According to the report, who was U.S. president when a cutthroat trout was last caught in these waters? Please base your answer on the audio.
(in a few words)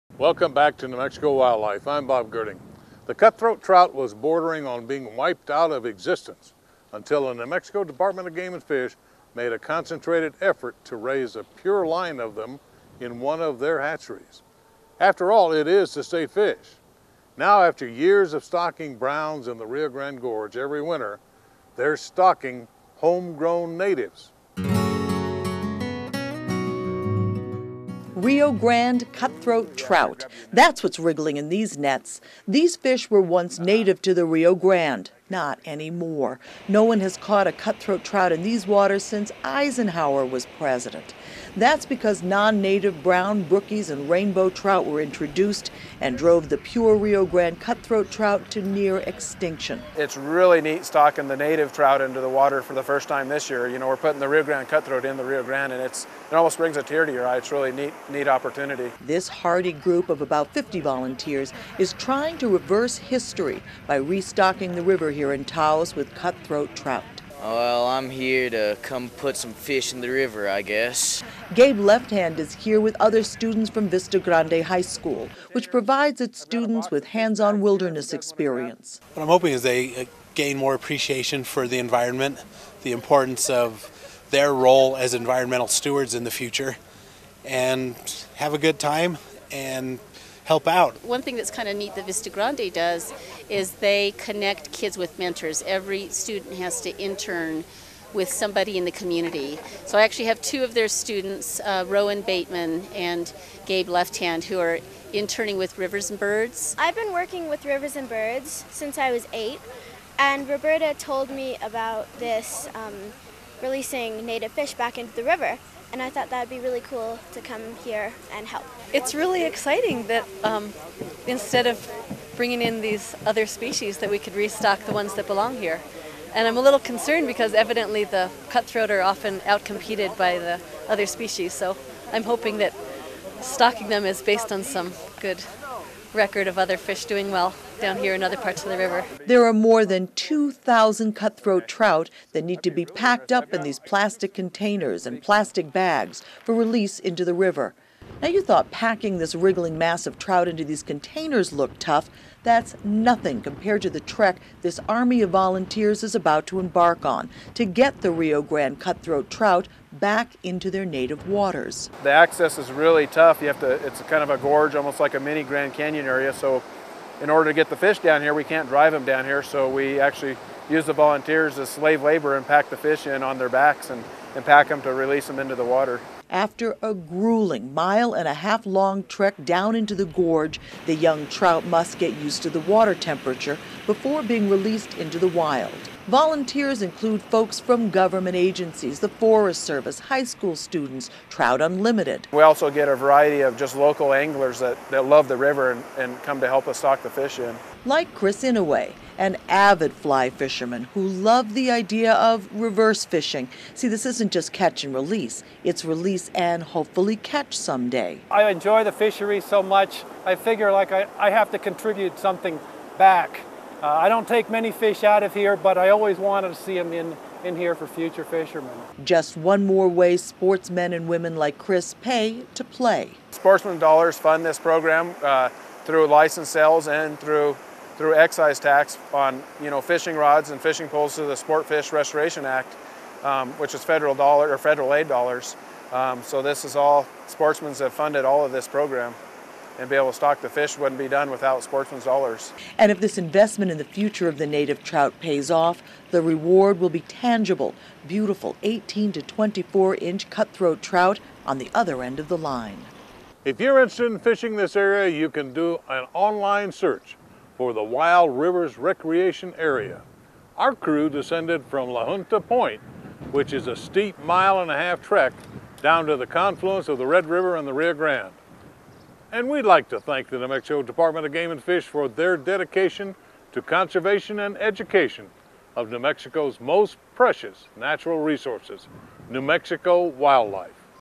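Eisenhower.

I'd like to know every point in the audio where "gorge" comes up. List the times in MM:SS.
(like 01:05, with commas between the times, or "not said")
00:20, 02:44, 03:00.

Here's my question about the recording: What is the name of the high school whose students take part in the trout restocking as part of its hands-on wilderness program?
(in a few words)
Vista Grande High School.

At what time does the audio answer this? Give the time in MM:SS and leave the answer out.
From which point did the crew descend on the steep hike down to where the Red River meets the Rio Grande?
04:21.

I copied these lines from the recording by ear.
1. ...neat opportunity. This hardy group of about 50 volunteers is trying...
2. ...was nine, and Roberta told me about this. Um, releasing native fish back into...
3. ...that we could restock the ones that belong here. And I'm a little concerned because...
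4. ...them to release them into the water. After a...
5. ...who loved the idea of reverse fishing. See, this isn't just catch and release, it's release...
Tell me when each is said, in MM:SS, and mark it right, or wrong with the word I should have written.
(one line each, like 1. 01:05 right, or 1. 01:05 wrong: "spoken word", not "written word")
1. 00:58 right
2. 01:49 wrong: "eight", not "nine"
3. 02:03 right
4. 02:54 right
5. 03:20 right.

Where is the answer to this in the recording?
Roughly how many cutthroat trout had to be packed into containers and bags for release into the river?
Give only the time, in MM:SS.
02:19.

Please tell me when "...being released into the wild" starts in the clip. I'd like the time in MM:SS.
03:04.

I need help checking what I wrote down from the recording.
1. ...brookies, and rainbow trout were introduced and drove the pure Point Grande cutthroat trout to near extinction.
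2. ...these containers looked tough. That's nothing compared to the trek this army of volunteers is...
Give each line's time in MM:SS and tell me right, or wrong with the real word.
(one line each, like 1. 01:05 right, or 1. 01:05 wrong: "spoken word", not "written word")
1. 00:43 wrong: "Rio", not "Point"
2. 02:30 right.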